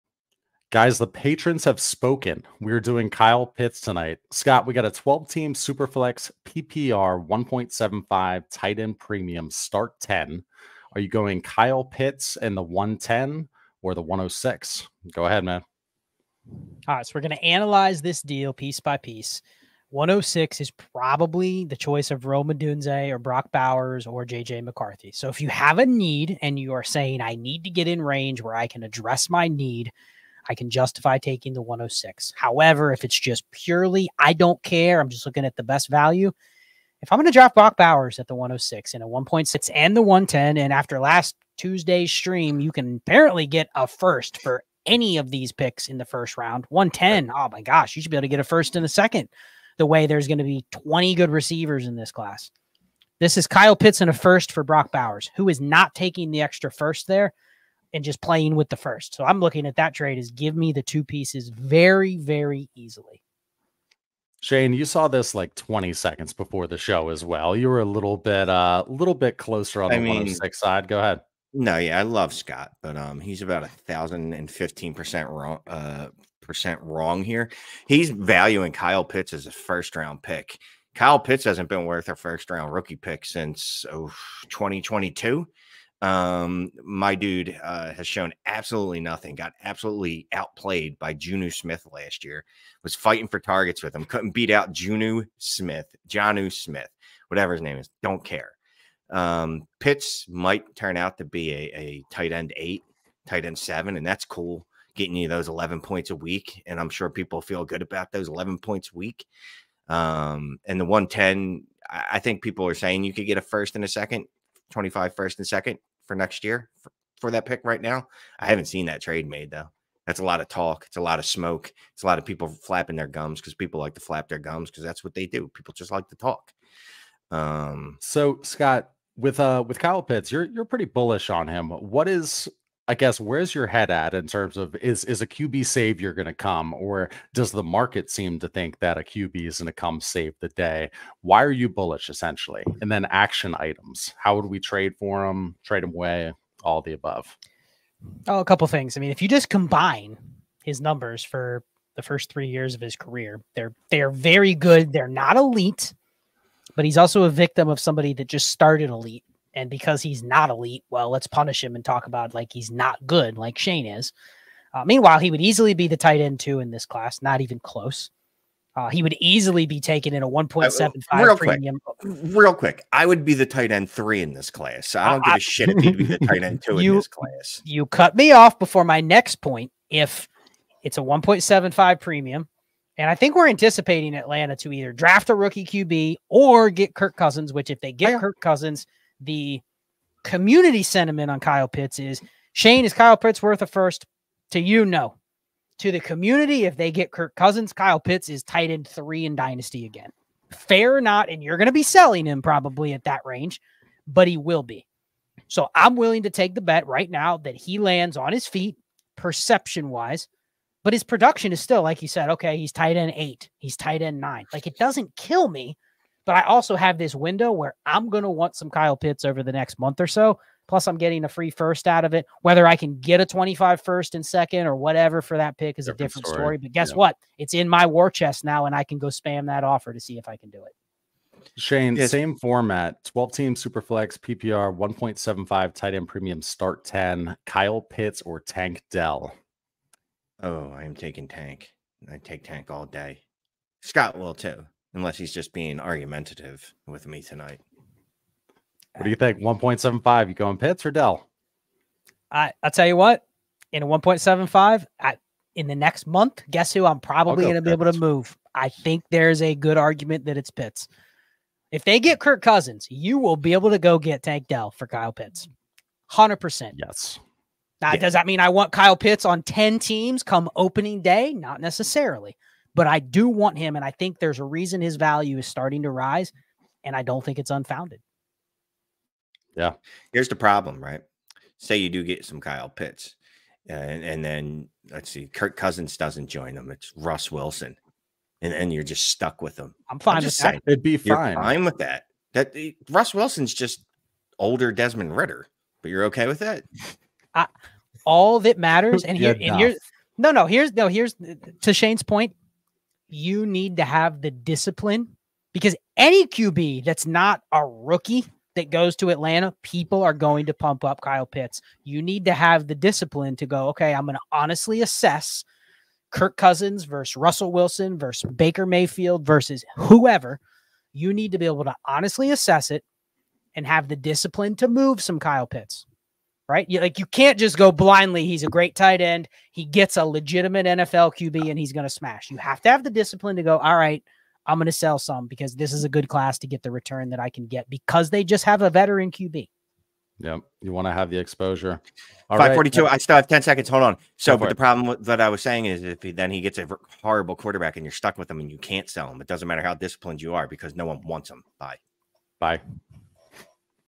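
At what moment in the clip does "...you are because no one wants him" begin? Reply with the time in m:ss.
5:50.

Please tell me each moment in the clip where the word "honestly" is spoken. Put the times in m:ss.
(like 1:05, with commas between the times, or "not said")
5:14, 5:21.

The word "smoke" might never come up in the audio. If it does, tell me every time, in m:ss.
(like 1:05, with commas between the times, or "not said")
2:01.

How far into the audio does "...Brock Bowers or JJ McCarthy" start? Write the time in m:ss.
0:23.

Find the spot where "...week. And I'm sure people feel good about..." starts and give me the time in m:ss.
1:46.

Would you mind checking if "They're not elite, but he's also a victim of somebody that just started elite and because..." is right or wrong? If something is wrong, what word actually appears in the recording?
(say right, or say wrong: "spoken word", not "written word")
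right.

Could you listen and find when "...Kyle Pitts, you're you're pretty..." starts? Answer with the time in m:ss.
2:09.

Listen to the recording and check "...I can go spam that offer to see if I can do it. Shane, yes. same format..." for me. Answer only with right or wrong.
right.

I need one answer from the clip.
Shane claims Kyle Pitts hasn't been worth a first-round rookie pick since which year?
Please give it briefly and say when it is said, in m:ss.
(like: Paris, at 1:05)
2022, at 1:24.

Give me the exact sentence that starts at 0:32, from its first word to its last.
However, if it's just purely, I don't care, I'm just looking at the best value.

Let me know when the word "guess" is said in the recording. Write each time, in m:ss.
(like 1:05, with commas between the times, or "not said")
2:12, 3:46, 4:16.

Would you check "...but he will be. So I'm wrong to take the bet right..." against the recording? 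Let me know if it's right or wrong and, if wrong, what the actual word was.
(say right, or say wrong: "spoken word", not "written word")
wrong: "willing", not "wrong".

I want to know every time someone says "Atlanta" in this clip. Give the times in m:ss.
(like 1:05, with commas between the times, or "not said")
3:04, 5:09.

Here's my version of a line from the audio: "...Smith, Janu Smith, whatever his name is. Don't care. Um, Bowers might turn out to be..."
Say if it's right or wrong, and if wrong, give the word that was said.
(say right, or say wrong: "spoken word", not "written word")
wrong: "Pitts", not "Bowers".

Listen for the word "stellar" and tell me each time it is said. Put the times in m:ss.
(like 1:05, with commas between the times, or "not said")
not said.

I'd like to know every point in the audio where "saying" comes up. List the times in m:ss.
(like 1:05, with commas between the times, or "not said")
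0:26, 1:52, 4:50, 5:45.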